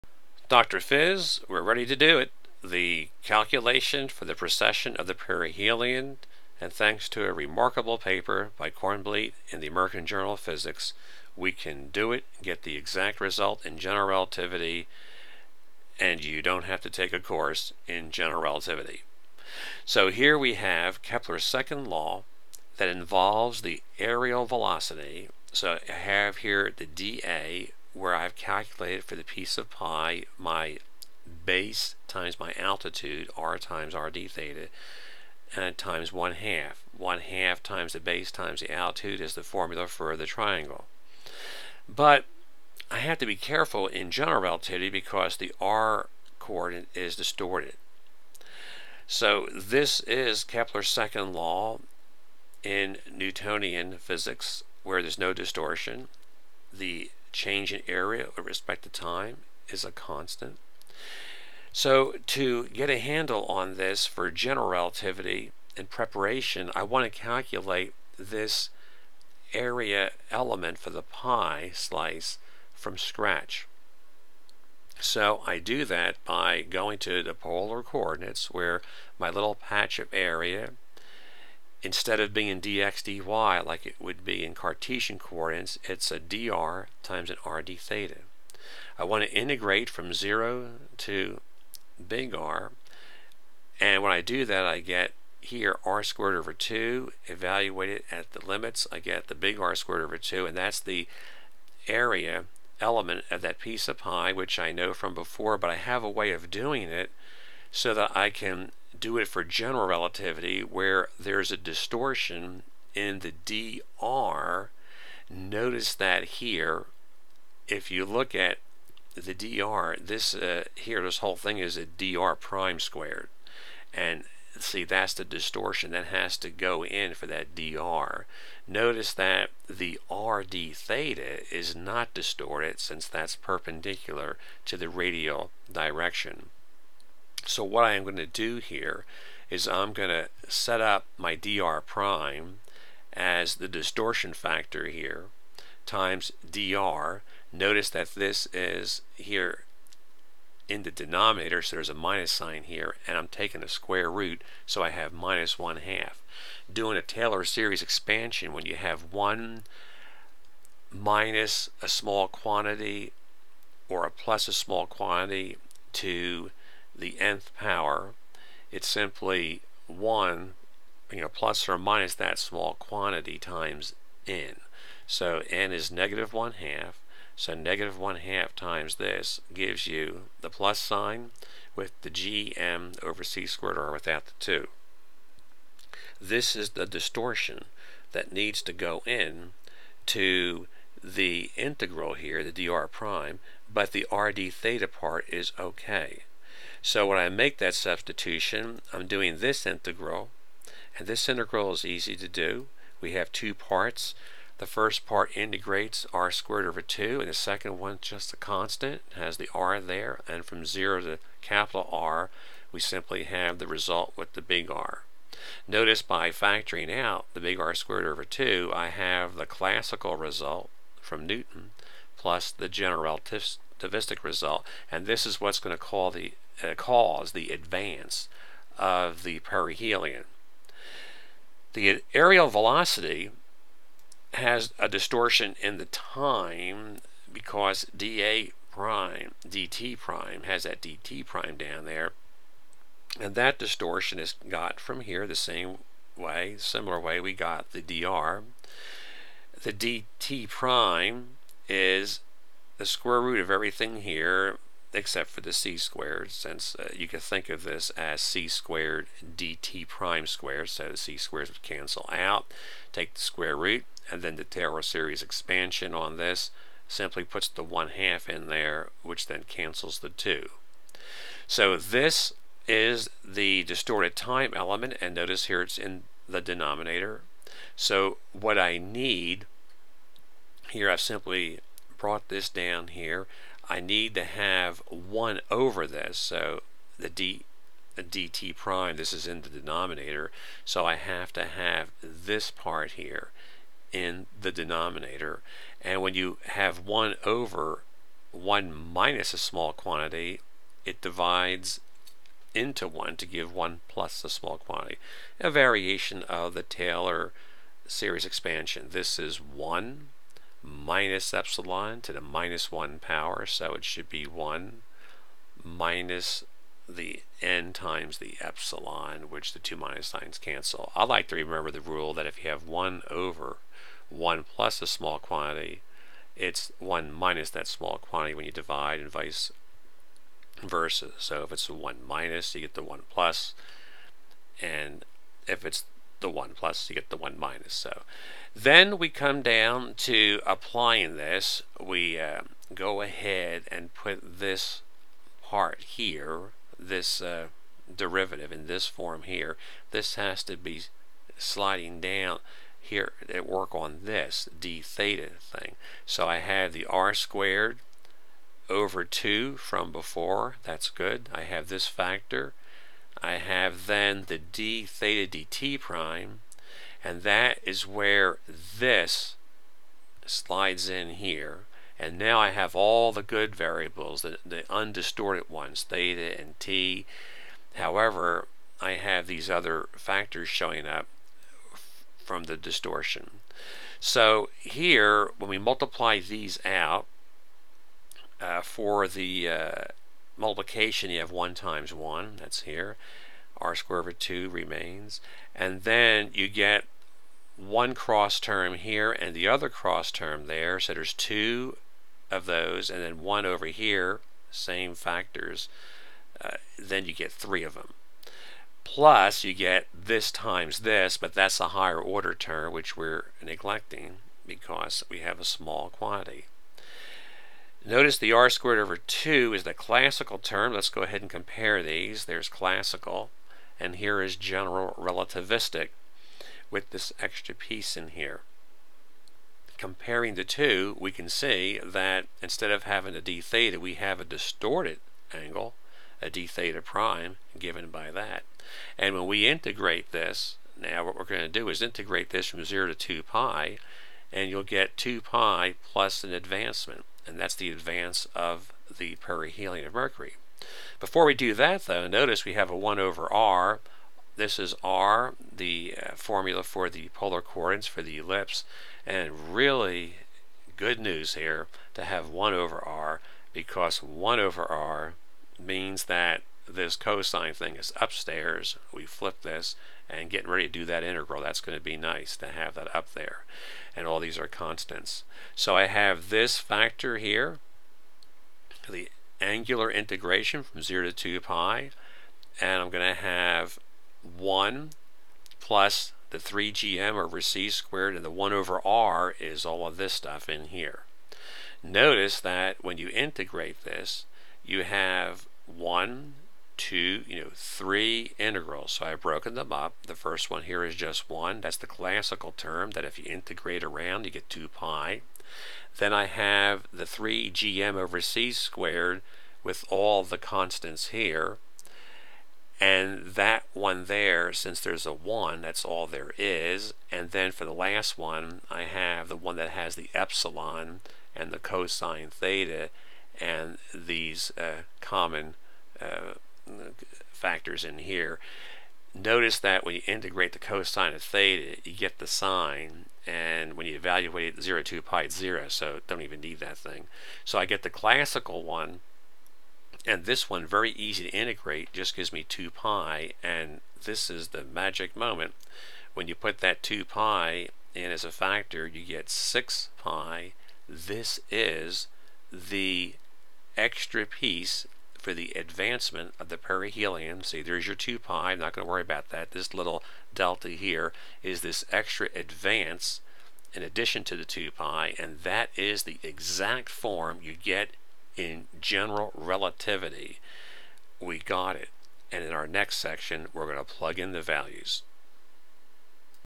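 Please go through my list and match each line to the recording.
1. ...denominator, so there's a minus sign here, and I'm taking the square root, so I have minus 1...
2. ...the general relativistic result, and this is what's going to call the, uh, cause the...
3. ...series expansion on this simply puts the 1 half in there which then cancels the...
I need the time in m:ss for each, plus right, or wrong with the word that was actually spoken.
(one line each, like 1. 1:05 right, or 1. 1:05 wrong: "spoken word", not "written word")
1. 2:30 right
2. 3:42 right
3. 4:24 right.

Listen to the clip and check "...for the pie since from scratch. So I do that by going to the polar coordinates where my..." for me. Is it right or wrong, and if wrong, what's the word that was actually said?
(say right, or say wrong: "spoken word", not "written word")
wrong: "slice", not "since".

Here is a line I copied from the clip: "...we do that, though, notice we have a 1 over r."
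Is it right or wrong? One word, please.
right.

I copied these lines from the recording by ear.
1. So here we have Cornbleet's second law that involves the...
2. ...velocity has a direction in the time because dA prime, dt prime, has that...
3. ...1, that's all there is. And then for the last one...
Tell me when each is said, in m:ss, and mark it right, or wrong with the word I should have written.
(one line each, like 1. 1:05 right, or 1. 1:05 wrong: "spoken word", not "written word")
1. 0:19 wrong: "Kepler", not "Cornbleet"
2. 3:52 wrong: "distortion", not "direction"
3. 8:35 right.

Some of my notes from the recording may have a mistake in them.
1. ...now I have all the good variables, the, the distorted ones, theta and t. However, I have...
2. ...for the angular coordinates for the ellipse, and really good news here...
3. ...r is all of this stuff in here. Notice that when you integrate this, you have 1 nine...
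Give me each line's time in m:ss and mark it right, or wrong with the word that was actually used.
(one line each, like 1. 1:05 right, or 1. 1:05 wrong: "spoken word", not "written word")
1. 6:12 wrong: "undistorted", not "distorted"
2. 7:36 wrong: "polar", not "angular"
3. 8:08 wrong: "two", not "nine".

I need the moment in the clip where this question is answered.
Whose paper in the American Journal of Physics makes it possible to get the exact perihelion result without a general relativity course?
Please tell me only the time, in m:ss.
0:08.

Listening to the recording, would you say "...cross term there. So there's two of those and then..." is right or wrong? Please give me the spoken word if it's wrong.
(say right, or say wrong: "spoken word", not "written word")
right.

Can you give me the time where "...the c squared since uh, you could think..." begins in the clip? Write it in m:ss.
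4:15.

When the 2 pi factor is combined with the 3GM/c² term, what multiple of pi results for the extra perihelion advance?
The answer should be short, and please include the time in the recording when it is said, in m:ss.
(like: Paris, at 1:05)
6 pi, at 9:09.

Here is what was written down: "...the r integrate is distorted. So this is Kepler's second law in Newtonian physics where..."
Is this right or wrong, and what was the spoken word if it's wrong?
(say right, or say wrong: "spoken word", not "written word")
wrong: "coordinate", not "integrate".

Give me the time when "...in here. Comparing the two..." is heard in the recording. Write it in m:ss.
7:07.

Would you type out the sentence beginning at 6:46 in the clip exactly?
Uh, then you get three of them.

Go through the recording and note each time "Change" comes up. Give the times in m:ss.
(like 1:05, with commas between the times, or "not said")
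0:57.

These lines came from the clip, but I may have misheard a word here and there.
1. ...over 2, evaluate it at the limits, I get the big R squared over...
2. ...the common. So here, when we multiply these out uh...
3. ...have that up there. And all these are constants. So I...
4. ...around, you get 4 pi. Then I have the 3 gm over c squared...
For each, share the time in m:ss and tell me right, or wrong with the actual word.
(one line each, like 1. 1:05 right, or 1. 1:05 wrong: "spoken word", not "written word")
1. 1:36 right
2. 6:22 wrong: "distortion", not "common"
3. 7:52 right
4. 8:23 wrong: "2", not "4".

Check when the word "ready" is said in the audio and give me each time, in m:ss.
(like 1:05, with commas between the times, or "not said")
0:01, 7:50.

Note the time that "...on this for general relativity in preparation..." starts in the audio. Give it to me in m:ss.
1:03.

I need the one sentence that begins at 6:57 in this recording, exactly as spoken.
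Notice the r squared over 2 is the classical term.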